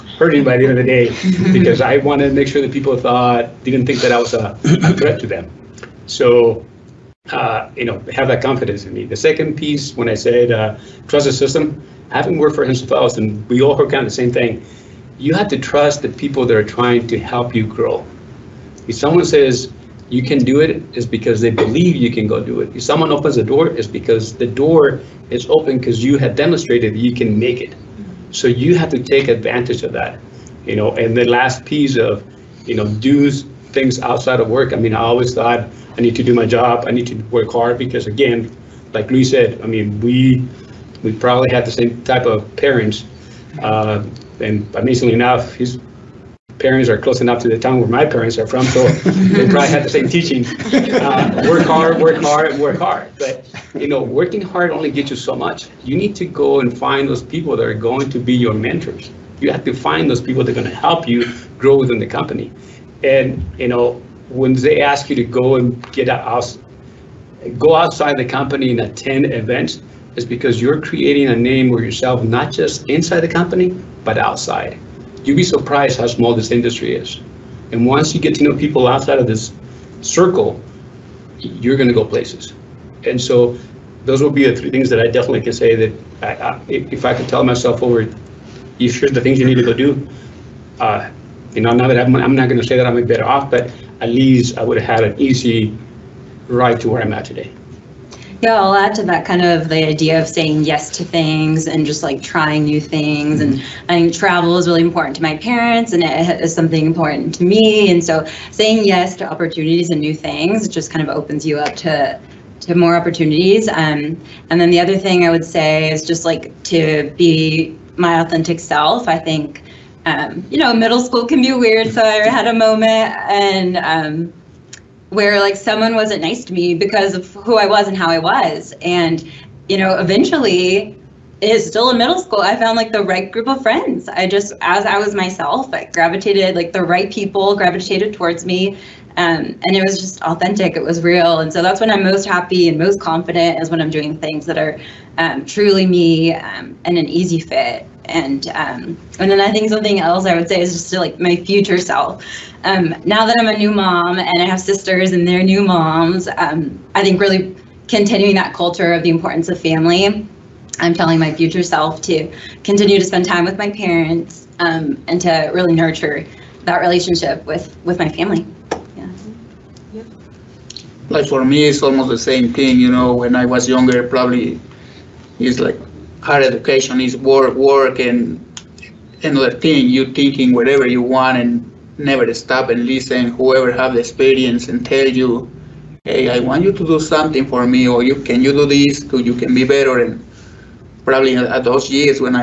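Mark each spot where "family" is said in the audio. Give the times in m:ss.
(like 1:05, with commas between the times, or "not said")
2:39, 2:48.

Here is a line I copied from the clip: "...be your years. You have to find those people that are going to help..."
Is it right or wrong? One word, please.
wrong.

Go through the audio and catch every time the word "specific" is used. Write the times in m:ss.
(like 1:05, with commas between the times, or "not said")
not said.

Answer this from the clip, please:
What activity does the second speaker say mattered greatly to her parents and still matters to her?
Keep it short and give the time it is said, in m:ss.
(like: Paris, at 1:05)
Travel, at 1:44.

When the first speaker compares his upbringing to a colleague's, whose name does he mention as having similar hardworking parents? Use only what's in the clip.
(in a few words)
Luis.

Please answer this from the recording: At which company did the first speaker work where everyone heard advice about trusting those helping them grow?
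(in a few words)
Hensel.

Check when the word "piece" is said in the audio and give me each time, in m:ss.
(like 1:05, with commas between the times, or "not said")
0:09, 0:31.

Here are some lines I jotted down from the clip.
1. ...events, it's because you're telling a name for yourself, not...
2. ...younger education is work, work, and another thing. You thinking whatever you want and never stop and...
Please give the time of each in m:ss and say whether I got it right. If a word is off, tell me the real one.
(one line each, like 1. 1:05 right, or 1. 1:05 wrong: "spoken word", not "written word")
1. 1:09 wrong: "creating", not "telling"
2. 2:56 wrong: "higher", not "younger".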